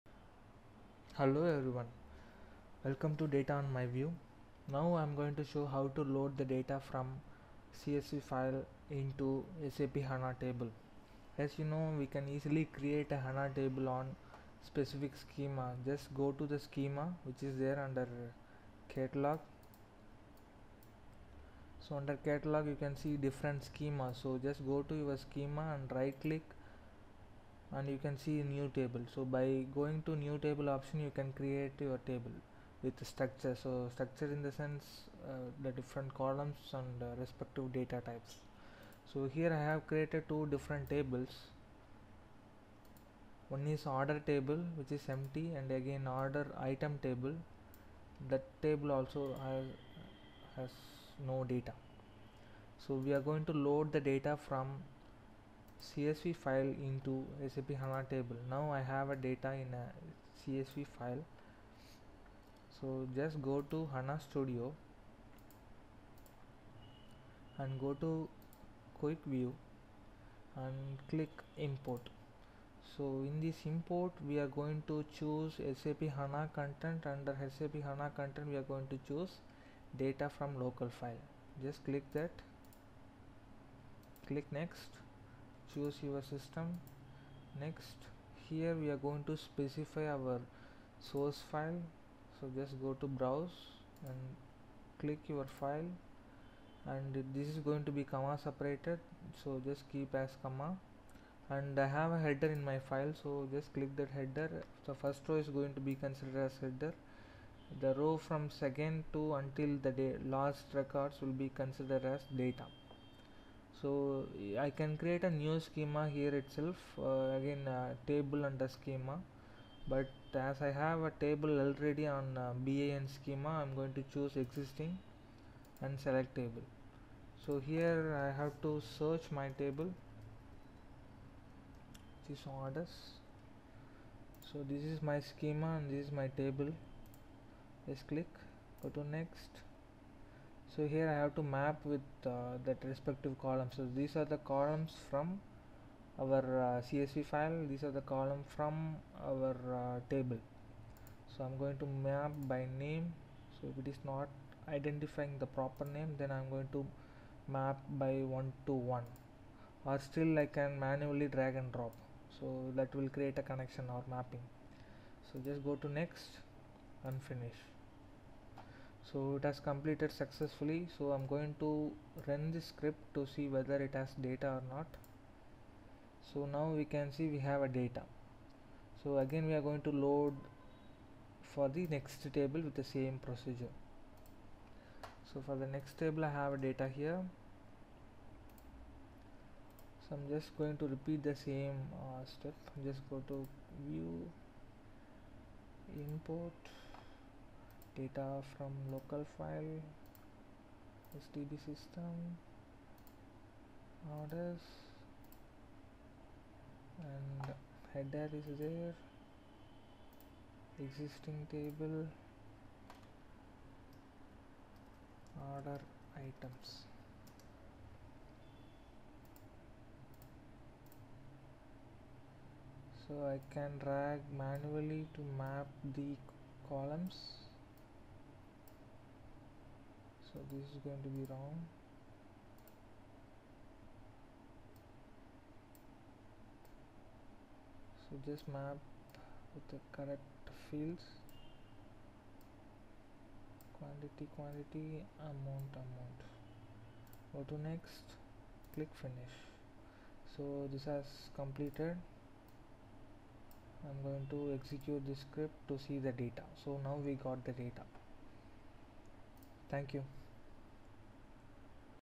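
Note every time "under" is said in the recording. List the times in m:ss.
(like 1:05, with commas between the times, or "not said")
0:17, 0:21, 1:17, 1:58.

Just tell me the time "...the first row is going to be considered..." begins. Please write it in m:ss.
1:44.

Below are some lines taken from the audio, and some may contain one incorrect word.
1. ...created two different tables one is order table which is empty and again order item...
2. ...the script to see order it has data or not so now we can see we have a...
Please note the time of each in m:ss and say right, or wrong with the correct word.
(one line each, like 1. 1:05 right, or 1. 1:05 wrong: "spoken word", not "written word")
1. 0:39 right
2. 2:52 wrong: "whether", not "order".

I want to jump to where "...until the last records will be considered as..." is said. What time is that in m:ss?
1:49.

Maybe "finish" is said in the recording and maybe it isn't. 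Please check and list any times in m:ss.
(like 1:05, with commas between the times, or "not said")
2:47, 4:09.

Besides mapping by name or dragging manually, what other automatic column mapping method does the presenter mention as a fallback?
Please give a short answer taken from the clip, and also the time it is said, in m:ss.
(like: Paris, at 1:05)
one to one, at 2:38.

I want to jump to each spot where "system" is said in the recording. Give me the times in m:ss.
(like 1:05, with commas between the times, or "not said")
1:26, 3:21.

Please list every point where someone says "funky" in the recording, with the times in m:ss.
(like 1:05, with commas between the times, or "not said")
not said.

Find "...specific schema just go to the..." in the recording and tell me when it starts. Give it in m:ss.
0:14.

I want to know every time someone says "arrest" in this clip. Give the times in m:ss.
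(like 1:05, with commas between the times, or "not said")
not said.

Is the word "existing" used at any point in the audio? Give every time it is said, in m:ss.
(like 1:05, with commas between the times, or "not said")
2:04, 3:30.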